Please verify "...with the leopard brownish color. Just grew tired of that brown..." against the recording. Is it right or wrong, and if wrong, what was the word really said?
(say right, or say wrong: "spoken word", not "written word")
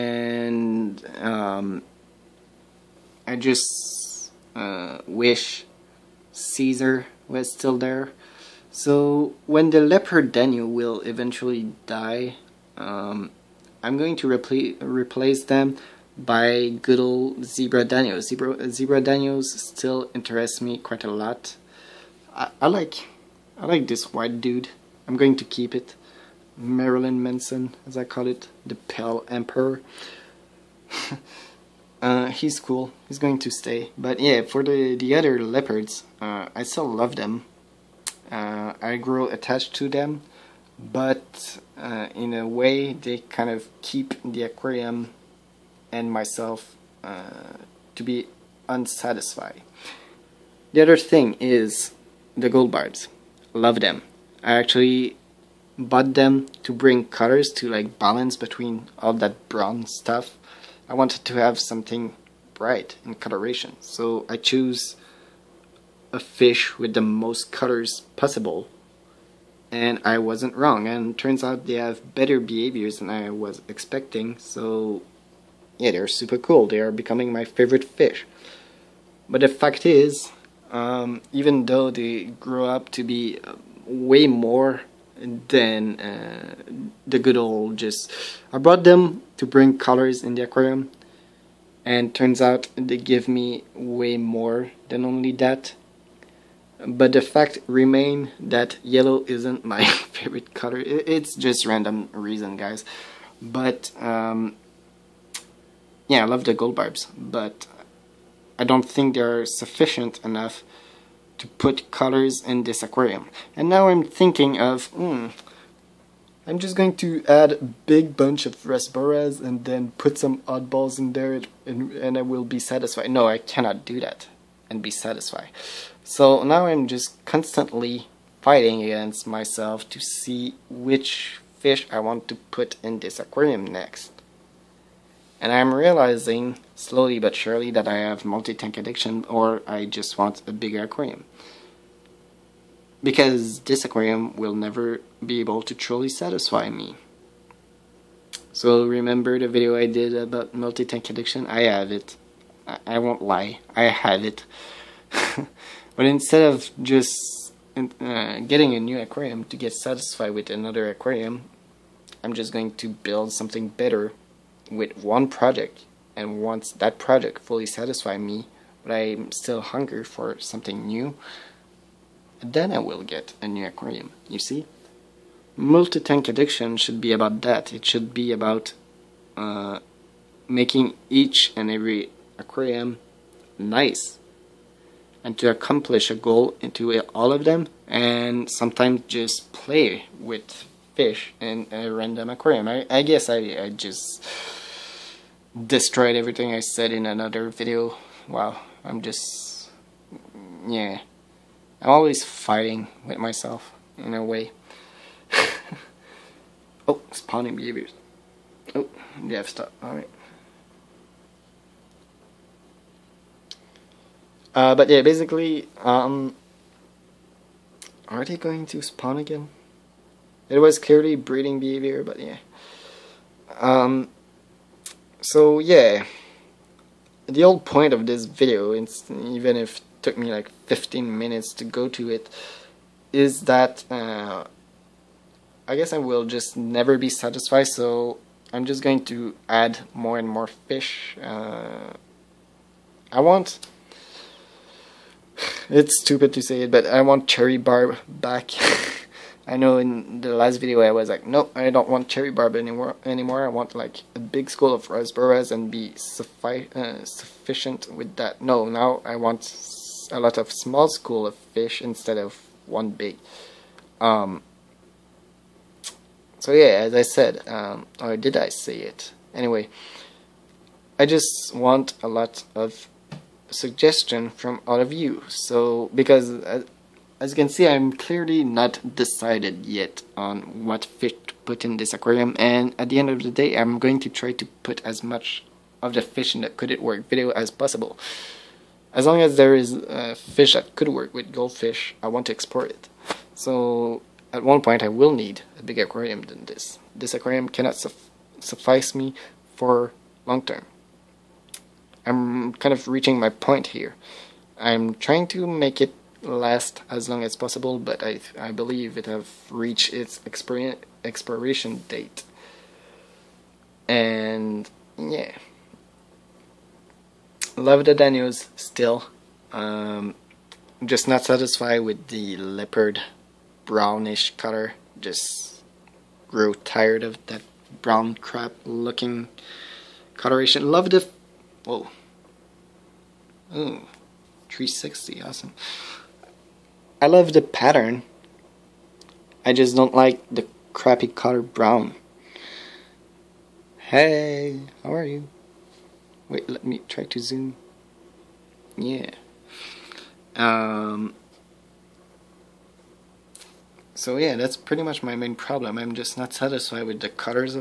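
right.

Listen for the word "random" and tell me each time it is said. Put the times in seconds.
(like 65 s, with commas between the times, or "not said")
101 s, 191 s.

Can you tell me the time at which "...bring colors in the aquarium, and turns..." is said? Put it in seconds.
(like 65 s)
89 s.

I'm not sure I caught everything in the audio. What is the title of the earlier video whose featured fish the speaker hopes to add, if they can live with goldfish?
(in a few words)
Could It Work.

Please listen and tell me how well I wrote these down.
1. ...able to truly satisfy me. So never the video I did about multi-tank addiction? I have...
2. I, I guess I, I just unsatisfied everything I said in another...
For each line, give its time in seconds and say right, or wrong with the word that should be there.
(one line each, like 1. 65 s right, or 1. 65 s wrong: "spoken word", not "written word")
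1. 145 s wrong: "remember", not "never"
2. 192 s wrong: "destroyed", not "unsatisfied".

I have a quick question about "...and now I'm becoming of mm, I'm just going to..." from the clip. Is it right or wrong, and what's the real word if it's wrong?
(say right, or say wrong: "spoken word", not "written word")
wrong: "thinking", not "becoming".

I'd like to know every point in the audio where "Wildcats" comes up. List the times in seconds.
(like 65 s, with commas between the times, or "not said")
not said.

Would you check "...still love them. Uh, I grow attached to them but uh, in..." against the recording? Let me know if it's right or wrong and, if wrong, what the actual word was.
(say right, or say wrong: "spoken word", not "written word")
right.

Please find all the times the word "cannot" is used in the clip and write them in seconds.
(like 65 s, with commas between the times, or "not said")
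123 s, 297 s.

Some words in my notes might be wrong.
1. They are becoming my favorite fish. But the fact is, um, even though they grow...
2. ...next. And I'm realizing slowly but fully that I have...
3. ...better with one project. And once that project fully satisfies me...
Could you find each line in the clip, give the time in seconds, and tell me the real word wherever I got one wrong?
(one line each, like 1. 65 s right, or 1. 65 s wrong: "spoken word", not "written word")
1. 76 s right
2. 133 s wrong: "surely", not "fully"
3. 163 s right.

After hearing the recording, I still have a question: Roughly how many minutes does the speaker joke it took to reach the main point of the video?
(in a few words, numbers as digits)
15.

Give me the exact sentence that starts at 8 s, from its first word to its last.
So when the leopard Danio will eventually die, um, I'm going to replace them by good old Zebra Danios.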